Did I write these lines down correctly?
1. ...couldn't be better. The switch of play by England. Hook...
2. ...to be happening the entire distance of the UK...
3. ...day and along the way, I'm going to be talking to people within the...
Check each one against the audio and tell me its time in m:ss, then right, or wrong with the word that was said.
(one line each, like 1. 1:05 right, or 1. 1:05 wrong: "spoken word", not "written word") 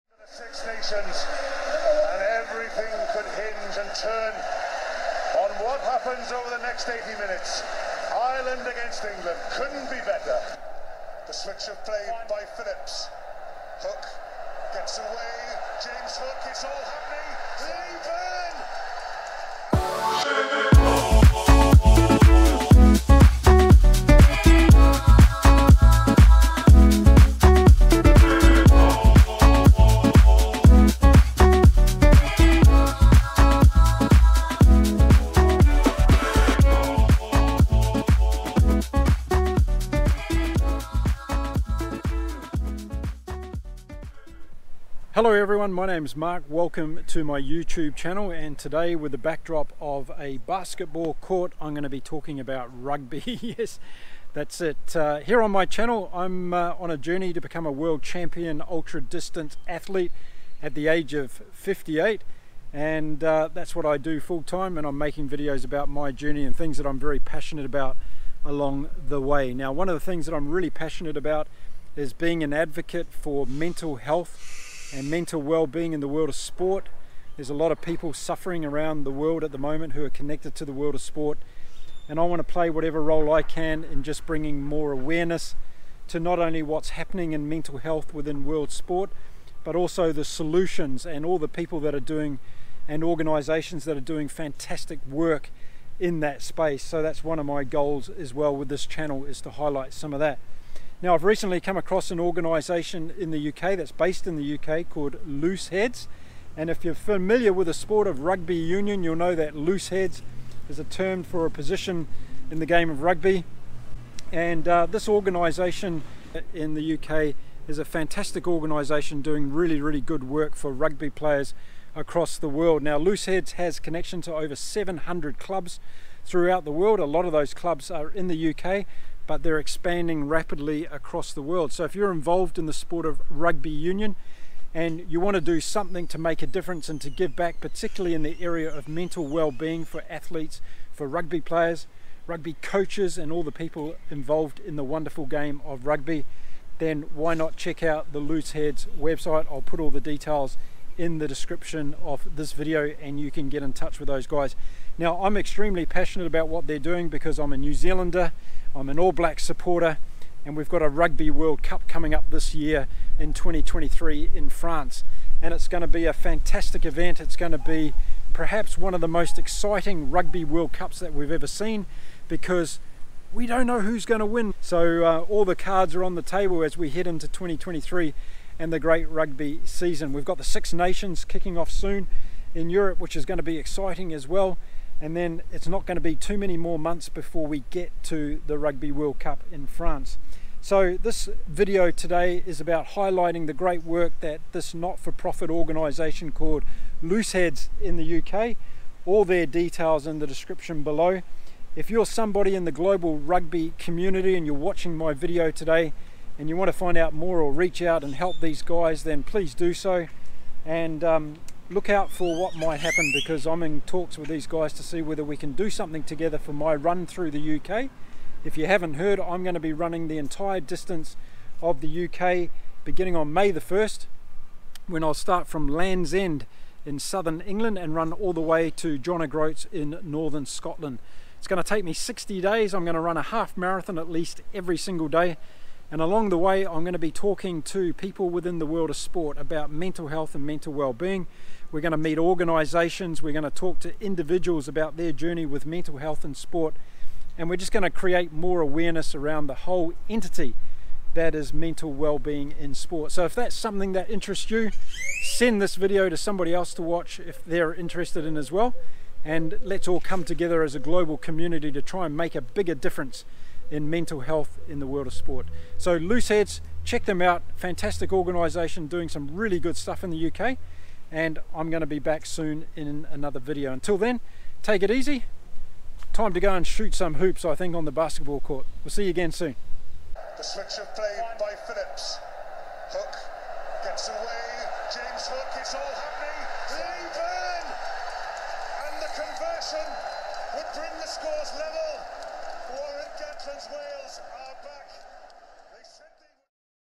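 1. 0:09 wrong: "Phillips", not "England"
2. 3:39 wrong: "running", not "happening"
3. 3:55 right.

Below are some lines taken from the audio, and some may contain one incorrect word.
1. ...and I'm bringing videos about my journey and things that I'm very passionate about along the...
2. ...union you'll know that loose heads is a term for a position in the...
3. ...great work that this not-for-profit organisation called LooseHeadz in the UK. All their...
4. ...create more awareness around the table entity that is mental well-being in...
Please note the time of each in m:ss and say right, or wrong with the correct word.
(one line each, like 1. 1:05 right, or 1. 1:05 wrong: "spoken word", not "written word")
1. 1:04 wrong: "making", not "bringing"
2. 1:48 right
3. 3:13 right
4. 4:07 wrong: "whole", not "table".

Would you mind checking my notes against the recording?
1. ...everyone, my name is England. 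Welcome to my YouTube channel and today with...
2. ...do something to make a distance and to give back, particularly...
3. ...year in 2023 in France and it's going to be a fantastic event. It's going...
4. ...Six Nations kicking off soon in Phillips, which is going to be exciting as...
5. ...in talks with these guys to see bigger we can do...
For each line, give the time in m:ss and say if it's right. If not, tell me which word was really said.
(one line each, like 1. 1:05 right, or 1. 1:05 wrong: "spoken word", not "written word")
1. 0:45 wrong: "Mark", not "England"
2. 2:15 wrong: "difference", not "distance"
3. 2:42 right
4. 3:00 wrong: "Europe", not "Phillips"
5. 3:33 wrong: "whether", not "bigger".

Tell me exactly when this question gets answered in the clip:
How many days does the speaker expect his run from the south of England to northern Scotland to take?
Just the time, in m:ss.
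3:51.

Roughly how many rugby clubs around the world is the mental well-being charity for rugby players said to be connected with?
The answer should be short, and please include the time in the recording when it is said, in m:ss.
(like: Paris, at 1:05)
700, at 2:04.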